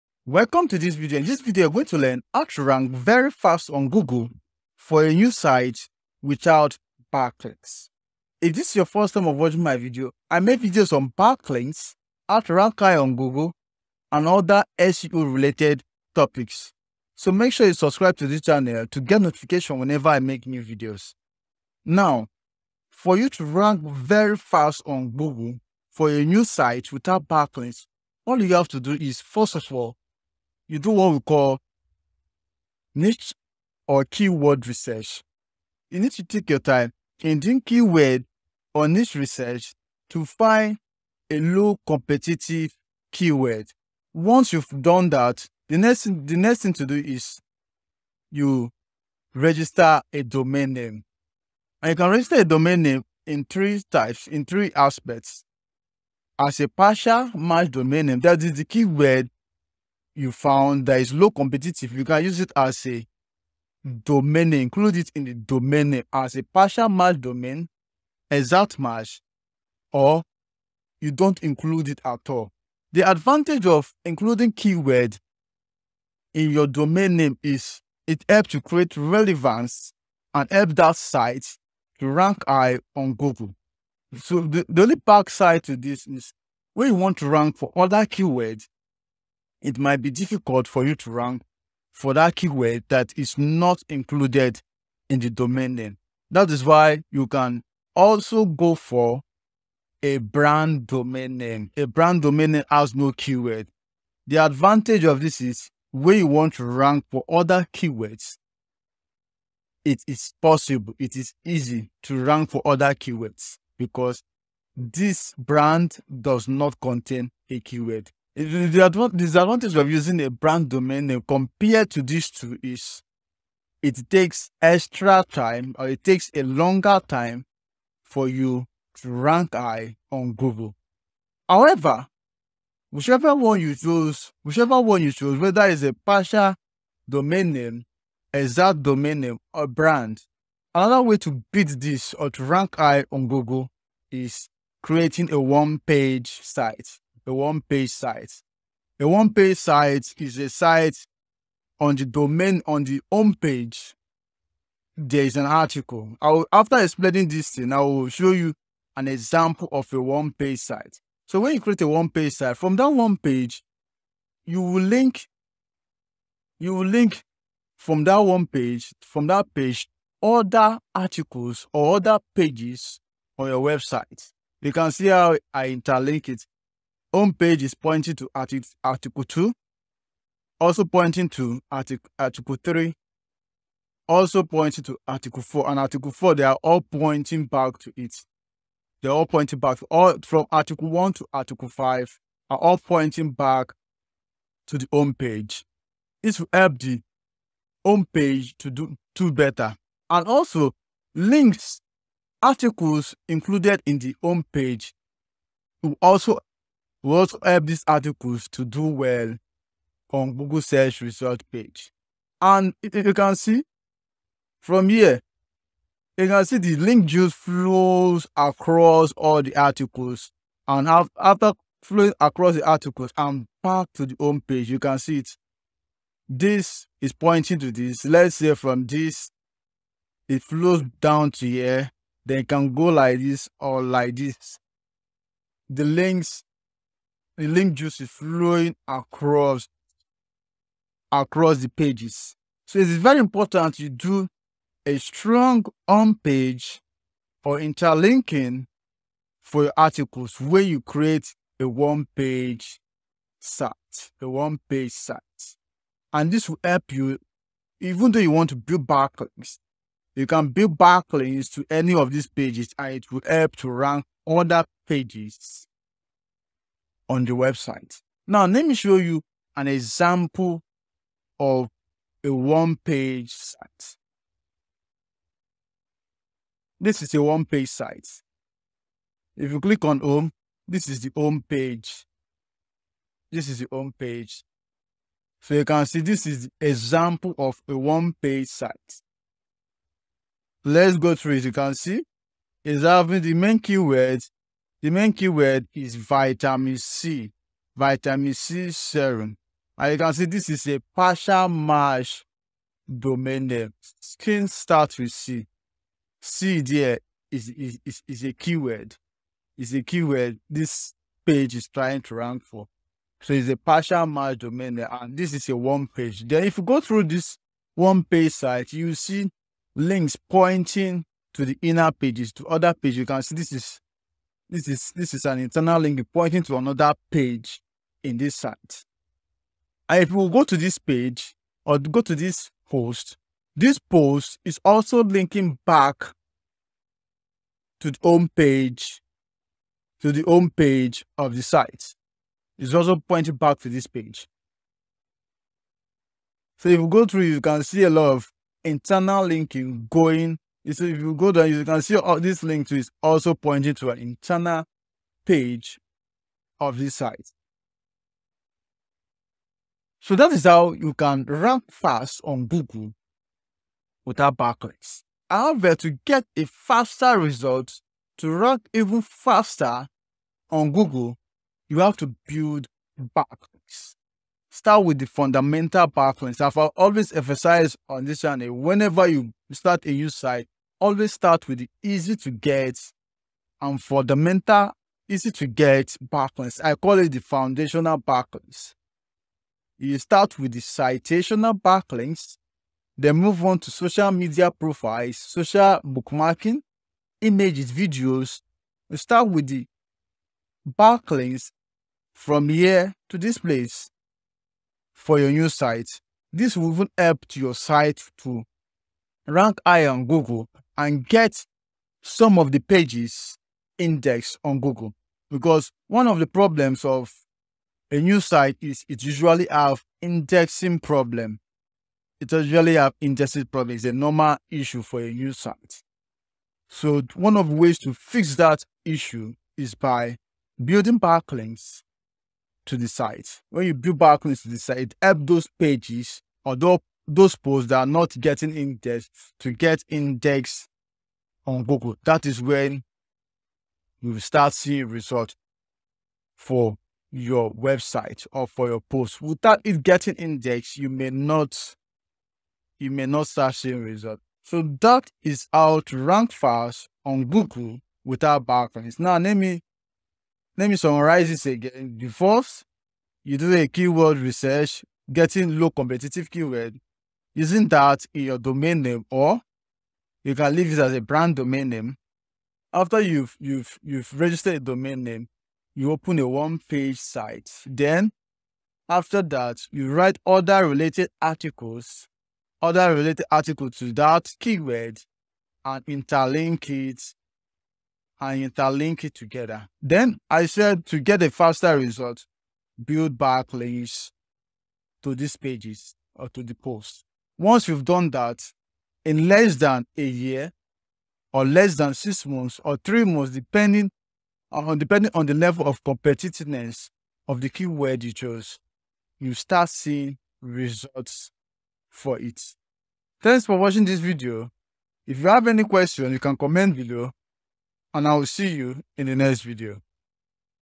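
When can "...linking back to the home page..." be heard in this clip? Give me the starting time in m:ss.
5:35.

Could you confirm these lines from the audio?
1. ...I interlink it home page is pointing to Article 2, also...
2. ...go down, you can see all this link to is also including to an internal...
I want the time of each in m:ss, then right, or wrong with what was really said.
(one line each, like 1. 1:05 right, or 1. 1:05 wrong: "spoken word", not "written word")
1. 2:55 right
2. 5:51 wrong: "pointing", not "including".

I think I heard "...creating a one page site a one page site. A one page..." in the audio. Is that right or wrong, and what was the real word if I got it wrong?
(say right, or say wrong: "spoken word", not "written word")
right.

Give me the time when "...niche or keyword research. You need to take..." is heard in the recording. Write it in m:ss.
0:32.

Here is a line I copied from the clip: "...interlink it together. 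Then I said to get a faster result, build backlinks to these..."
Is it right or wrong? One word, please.
right.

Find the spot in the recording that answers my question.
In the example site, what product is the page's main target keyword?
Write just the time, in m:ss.
4:57.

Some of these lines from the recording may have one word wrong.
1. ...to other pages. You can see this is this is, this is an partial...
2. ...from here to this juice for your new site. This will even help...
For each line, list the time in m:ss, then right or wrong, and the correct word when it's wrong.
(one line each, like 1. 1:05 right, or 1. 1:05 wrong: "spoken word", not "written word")
1. 5:22 wrong: "internal", not "partial"
2. 6:42 wrong: "place", not "juice".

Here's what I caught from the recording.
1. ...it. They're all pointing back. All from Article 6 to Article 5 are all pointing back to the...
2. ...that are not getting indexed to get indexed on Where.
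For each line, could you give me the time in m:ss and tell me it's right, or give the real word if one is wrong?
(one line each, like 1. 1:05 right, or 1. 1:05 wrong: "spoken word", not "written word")
1. 3:07 wrong: "1", not "6"
2. 7:17 wrong: "Google", not "Where".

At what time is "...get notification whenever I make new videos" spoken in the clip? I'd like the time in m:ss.
0:19.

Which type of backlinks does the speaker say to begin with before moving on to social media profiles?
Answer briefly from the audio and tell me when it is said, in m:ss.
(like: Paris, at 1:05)
Citational backlinks, at 6:30.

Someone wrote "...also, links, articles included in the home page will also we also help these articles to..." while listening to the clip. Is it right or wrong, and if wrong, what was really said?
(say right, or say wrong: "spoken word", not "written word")
right.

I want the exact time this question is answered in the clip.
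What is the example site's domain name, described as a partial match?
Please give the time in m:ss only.
5:03.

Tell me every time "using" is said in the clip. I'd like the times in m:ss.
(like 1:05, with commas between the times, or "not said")
1:59, 7:47.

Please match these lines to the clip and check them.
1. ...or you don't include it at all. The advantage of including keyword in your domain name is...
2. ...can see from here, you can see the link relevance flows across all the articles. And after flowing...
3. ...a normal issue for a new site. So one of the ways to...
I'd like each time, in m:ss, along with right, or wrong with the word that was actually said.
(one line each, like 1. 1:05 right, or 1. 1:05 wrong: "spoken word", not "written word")
1. 1:09 right
2. 3:33 wrong: "juice", not "relevance"
3. 7:03 right.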